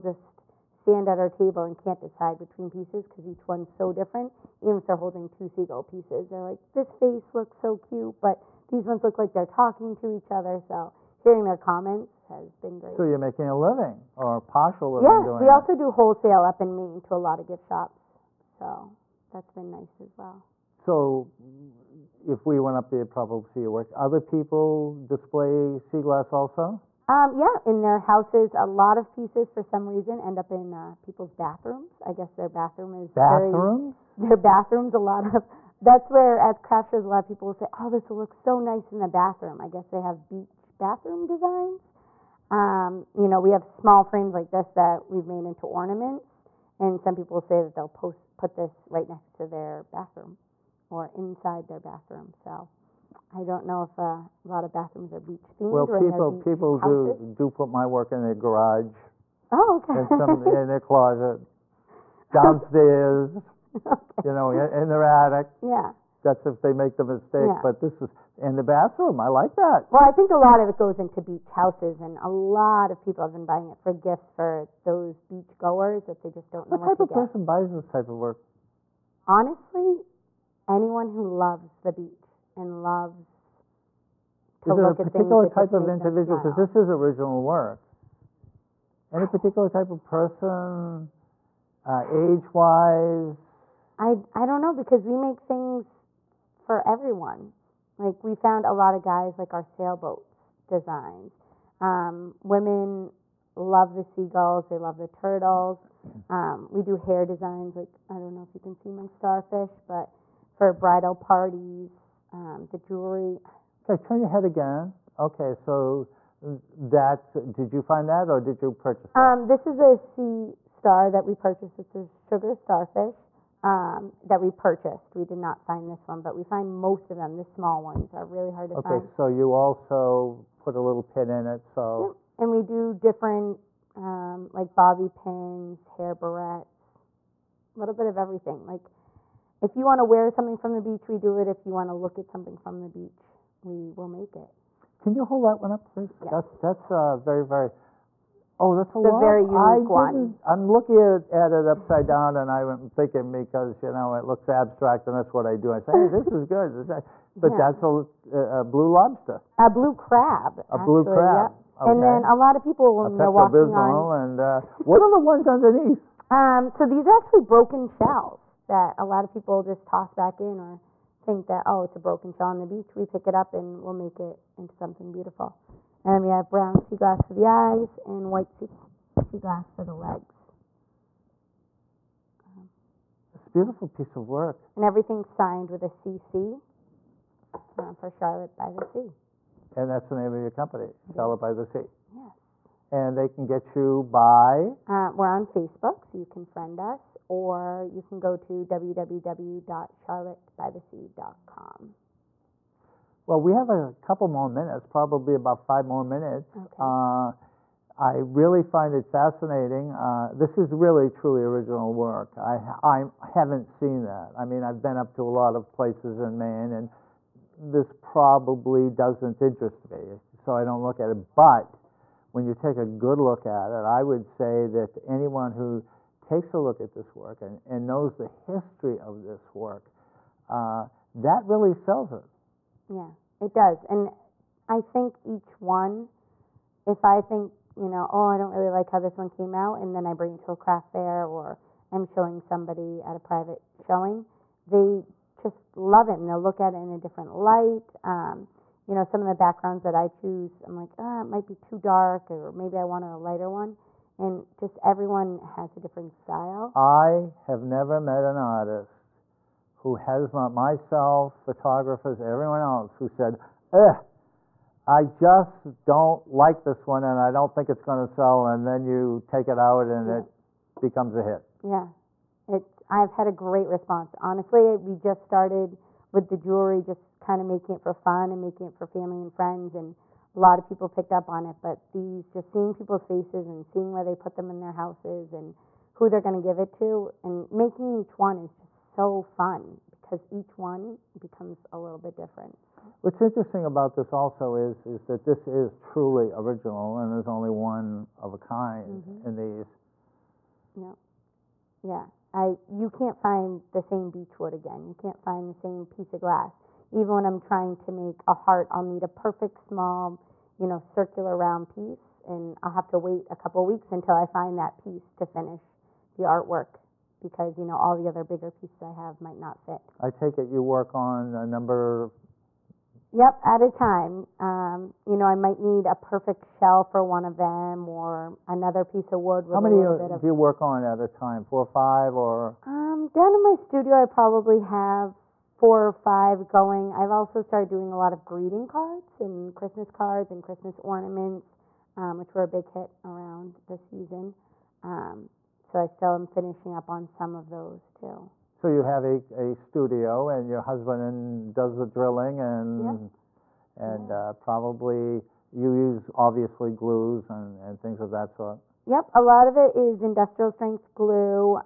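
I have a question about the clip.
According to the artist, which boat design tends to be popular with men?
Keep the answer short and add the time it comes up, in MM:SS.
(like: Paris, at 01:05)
sailboats, at 01:39.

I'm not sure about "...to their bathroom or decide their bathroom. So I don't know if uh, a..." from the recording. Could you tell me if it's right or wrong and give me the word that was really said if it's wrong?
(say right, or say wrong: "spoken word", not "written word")
wrong: "inside", not "decide".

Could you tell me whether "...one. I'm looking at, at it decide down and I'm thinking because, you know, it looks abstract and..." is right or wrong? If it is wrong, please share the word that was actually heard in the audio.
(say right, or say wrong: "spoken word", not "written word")
wrong: "upside", not "decide".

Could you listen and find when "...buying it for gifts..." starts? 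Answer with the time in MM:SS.
01:13.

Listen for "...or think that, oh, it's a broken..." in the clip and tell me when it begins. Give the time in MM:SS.
02:50.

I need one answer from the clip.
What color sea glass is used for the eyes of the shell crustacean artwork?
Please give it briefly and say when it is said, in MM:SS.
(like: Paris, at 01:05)
brown, at 02:56.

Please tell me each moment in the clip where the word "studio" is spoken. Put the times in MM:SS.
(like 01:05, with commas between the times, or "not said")
05:33, 05:49.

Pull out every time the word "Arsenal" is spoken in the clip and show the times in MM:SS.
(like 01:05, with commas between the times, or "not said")
not said.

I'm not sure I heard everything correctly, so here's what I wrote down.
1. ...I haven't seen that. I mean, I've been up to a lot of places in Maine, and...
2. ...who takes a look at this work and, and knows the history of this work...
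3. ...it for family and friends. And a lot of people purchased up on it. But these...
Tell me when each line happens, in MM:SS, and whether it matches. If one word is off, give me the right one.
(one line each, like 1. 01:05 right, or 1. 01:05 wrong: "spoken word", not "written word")
1. 03:32 right
2. 03:45 right
3. 04:38 wrong: "picked", not "purchased".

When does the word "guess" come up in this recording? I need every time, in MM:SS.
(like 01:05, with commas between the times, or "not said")
00:32, 00:39.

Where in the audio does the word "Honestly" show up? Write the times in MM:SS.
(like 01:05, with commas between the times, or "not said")
01:19, 04:34.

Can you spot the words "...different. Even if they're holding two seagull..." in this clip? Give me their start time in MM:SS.
00:03.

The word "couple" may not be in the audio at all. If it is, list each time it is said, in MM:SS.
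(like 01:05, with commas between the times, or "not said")
03:23, 05:13.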